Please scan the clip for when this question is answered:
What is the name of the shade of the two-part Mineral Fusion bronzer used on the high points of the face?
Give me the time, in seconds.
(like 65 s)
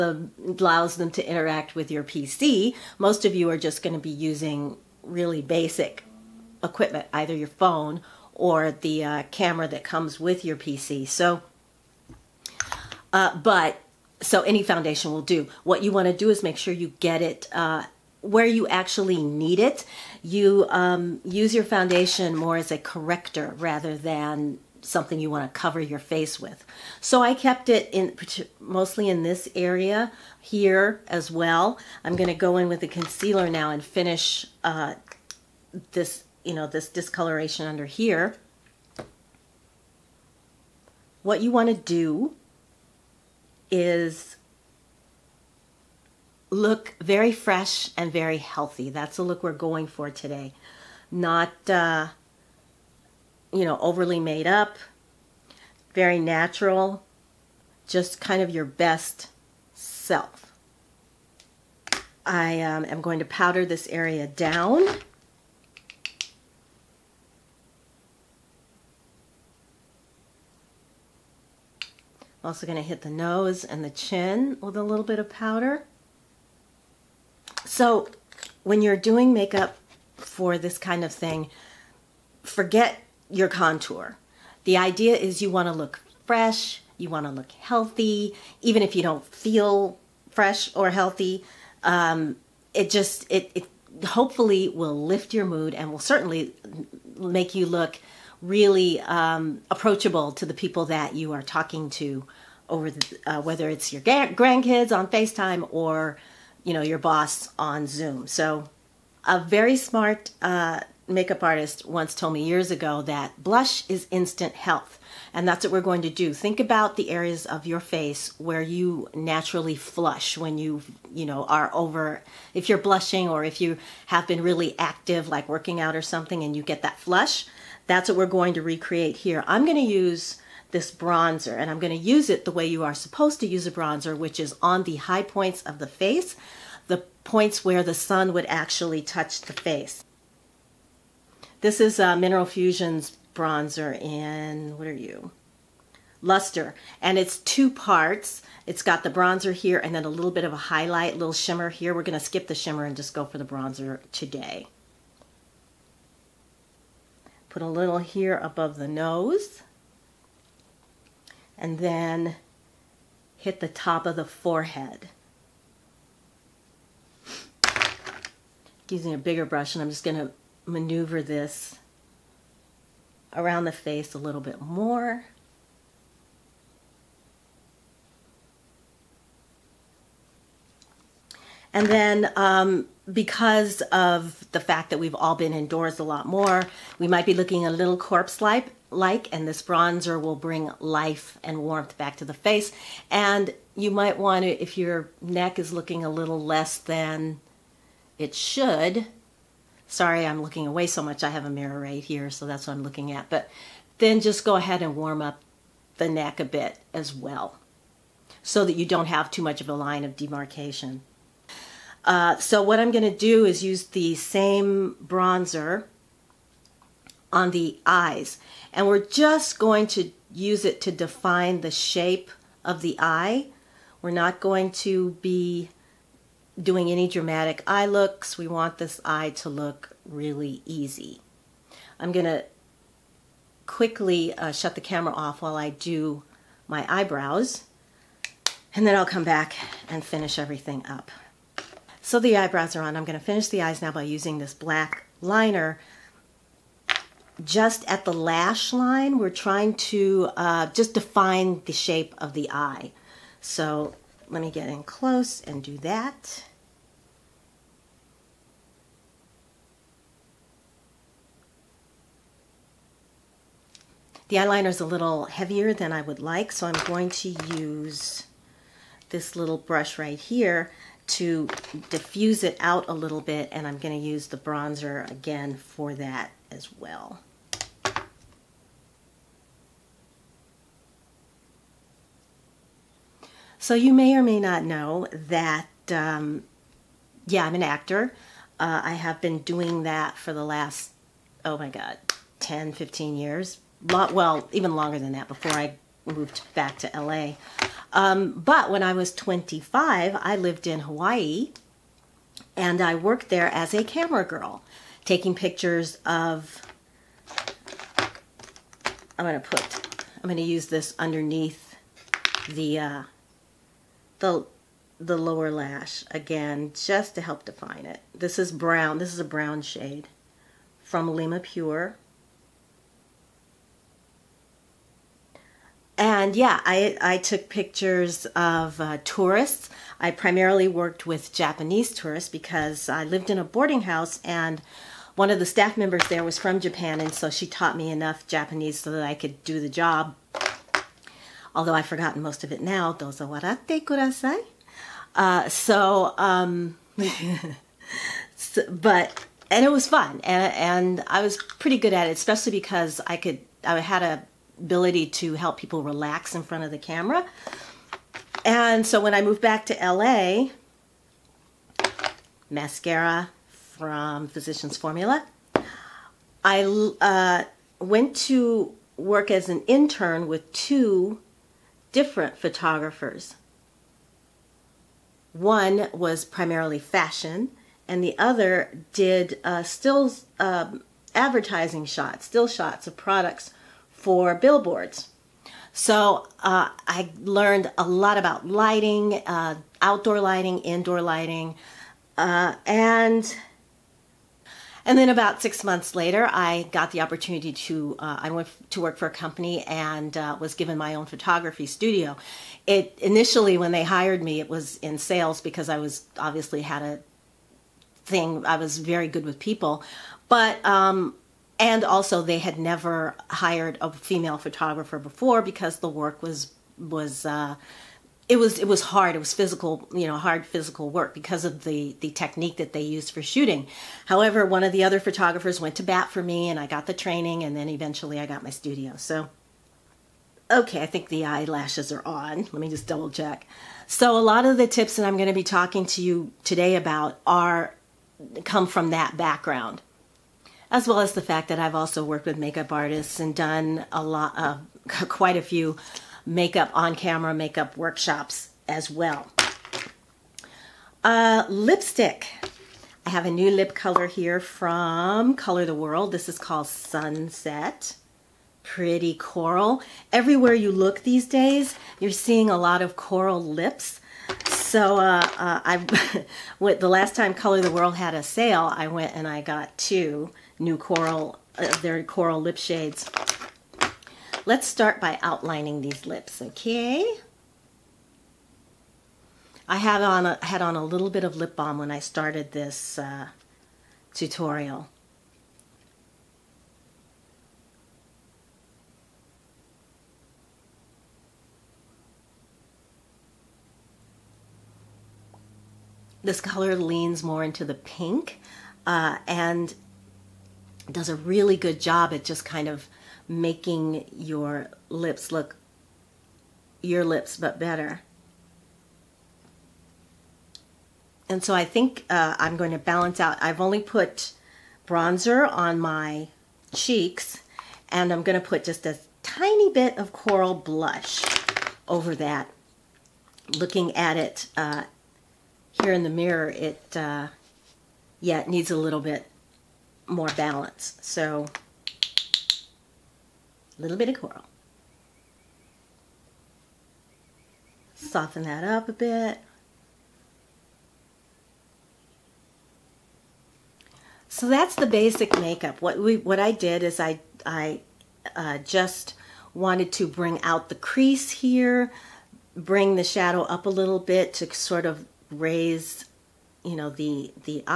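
146 s.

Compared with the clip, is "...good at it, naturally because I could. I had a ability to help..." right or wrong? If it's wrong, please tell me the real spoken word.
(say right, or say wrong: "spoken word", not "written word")
wrong: "especially", not "naturally".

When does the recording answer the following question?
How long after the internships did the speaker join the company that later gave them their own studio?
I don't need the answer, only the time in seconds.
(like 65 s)
395 s.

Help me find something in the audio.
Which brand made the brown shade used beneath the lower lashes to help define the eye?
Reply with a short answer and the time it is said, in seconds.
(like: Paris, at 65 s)
Alima Pure, at 321 s.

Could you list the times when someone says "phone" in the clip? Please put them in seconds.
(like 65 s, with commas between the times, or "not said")
7 s.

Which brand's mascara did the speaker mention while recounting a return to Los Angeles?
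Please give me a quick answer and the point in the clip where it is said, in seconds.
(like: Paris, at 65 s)
Physicians Formula, at 364 s.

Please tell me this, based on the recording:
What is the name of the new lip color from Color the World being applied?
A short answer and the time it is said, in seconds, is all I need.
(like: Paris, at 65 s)
Sunset, at 456 s.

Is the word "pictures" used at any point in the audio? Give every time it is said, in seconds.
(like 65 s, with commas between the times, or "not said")
305 s, 327 s.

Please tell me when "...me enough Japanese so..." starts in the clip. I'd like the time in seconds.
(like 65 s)
337 s.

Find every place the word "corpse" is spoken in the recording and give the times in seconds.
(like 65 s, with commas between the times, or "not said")
187 s.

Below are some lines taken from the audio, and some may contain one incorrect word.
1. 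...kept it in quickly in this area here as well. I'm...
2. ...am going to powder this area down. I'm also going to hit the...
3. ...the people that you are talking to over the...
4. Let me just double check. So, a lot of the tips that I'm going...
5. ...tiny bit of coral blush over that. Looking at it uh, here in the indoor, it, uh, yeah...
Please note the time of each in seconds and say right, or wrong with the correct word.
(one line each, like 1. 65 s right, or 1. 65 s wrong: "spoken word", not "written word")
1. 27 s wrong: "mostly", not "quickly"
2. 62 s right
3. 100 s right
4. 432 s right
5. 519 s wrong: "mirror", not "indoor".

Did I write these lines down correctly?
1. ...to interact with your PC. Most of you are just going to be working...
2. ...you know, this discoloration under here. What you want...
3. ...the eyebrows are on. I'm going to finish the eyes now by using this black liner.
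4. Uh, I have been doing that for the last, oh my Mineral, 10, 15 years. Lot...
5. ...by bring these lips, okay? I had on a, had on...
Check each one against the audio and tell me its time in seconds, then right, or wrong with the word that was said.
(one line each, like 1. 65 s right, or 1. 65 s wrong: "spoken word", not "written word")
1. 1 s wrong: "using", not "working"
2. 36 s right
3. 242 s right
4. 288 s wrong: "God", not "Mineral"
5. 475 s wrong: "outlining", not "bring".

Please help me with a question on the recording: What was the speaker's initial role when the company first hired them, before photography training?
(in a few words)
sales.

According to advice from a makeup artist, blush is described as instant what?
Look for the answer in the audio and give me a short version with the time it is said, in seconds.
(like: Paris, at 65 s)
health, at 114 s.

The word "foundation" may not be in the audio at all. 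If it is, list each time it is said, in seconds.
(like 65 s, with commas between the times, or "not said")
14 s, 21 s.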